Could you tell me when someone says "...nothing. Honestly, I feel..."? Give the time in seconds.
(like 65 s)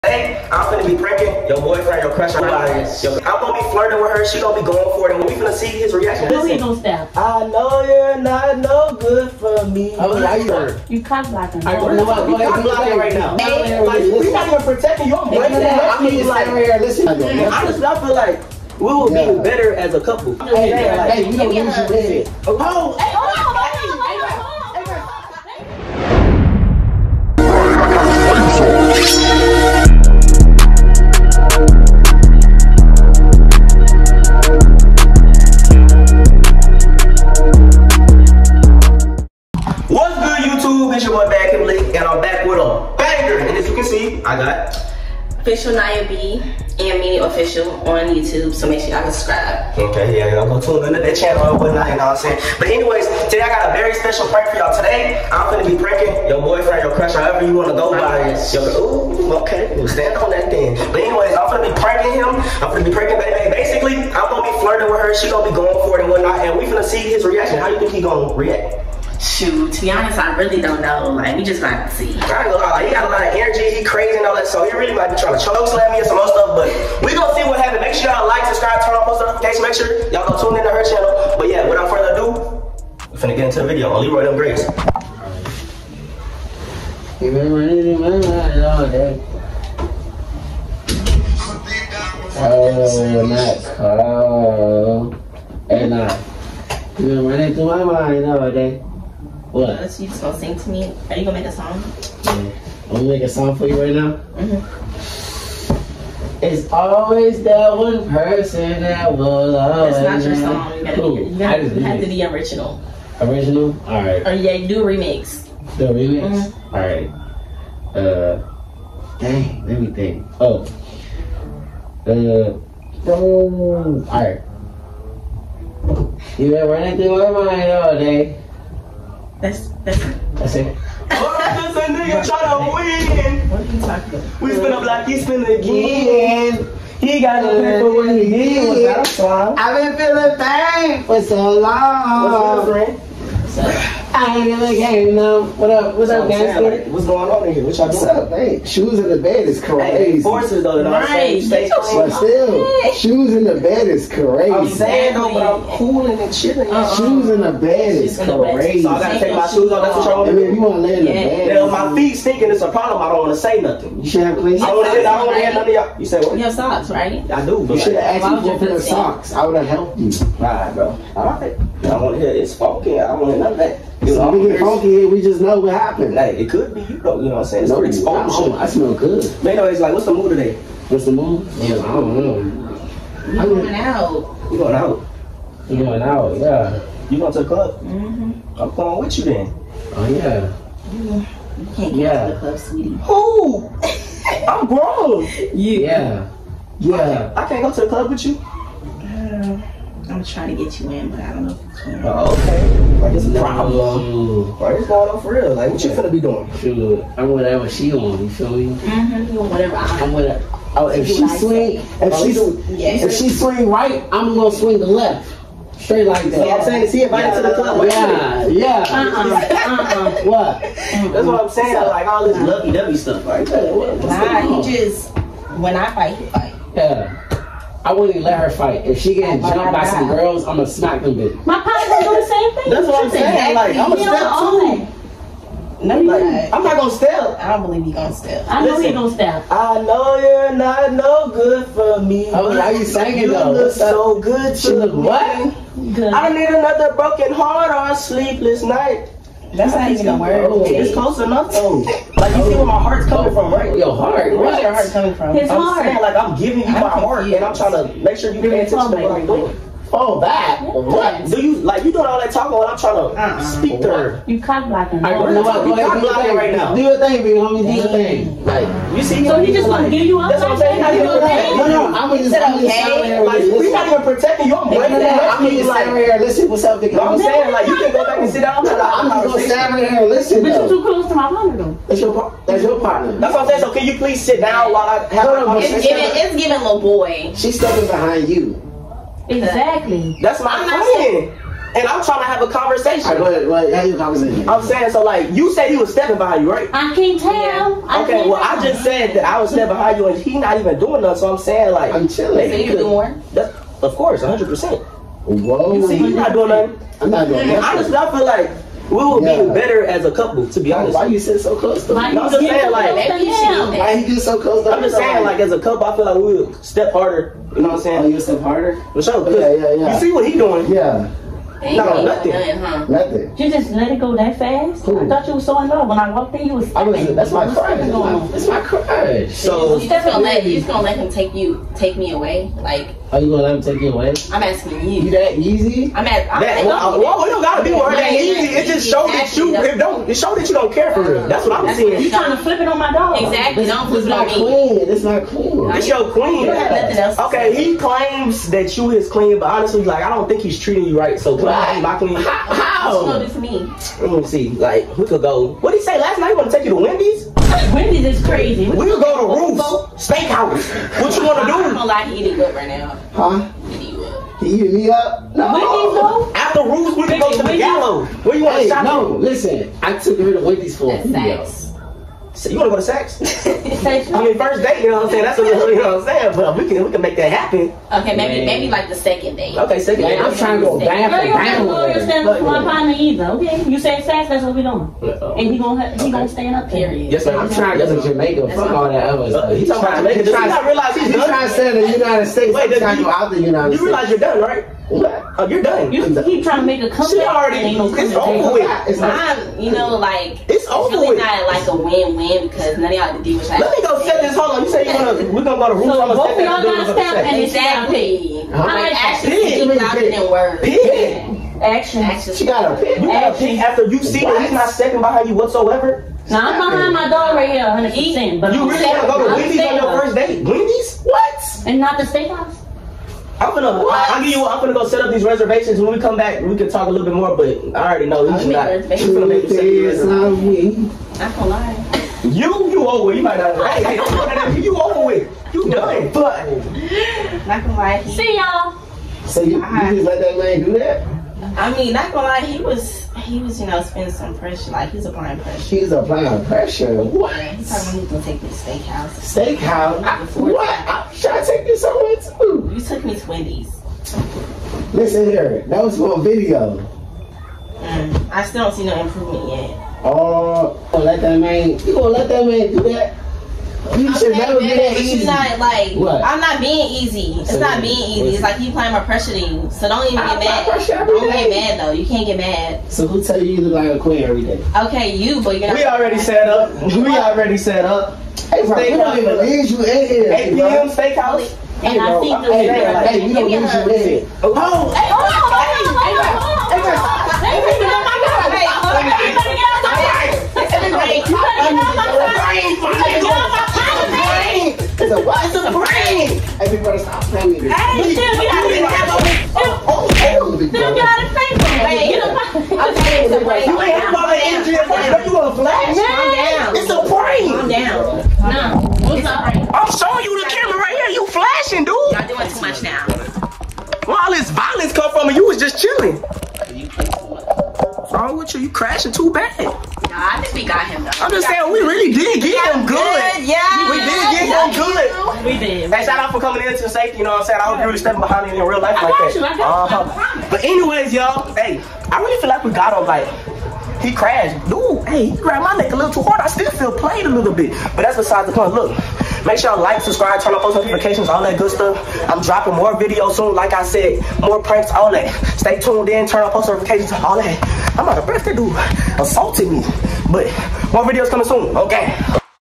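307 s.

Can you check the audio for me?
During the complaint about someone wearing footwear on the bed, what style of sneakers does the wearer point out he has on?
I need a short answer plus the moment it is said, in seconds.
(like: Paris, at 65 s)
Forces, at 150 s.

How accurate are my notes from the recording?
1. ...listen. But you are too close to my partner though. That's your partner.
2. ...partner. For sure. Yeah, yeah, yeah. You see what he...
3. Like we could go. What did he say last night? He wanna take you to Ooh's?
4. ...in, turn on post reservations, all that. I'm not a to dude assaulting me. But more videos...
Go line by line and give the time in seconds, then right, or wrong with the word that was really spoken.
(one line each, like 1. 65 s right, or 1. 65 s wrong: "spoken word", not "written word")
1. 280 s right
2. 318 s wrong: "harder", not "partner"
3. 354 s wrong: "Wendy", not "Ooh"
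4. 546 s wrong: "notifications", not "reservations".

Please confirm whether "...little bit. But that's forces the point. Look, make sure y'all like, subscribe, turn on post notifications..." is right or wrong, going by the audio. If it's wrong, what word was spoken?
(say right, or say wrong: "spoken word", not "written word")
wrong: "besides", not "forces".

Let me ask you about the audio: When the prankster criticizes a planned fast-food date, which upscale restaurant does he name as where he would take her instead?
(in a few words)
Ruth's Steakhouse.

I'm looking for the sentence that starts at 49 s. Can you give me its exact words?
Okay, yeah, y'all go tune into that channel and whatnot, you know what I'm saying?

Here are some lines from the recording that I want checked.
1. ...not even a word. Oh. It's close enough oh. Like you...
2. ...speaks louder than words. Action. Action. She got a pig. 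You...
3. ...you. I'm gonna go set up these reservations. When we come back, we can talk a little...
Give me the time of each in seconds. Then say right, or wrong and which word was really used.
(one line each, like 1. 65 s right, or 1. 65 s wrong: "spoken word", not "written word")
1. 249 s right
2. 409 s right
3. 424 s right.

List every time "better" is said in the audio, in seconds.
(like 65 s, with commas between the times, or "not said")
19 s, 309 s.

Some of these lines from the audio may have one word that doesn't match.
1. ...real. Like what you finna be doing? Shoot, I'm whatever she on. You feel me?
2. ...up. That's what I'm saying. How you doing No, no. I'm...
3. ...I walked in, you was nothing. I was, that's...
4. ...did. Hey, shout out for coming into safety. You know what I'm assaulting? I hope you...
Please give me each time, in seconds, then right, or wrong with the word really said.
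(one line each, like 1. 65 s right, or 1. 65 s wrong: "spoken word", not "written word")
1. 205 s right
2. 270 s right
3. 325 s wrong: "stepping", not "nothing"
4. 525 s wrong: "saying", not "assaulting".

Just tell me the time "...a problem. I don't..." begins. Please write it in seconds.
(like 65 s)
162 s.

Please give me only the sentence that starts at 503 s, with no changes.
You ain't have all that energy at first.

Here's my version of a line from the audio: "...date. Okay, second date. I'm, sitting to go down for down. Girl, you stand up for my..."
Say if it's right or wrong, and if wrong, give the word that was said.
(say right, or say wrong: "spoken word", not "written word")
wrong: "trying", not "sitting".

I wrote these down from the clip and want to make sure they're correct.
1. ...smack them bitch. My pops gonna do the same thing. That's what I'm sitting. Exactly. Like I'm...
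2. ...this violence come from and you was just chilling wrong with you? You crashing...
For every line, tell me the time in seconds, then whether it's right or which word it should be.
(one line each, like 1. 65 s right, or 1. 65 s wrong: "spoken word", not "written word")
1. 230 s wrong: "saying", not "sitting"
2. 514 s right.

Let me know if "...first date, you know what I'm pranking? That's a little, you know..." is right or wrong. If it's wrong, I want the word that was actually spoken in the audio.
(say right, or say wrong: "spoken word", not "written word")
wrong: "saying", not "pranking".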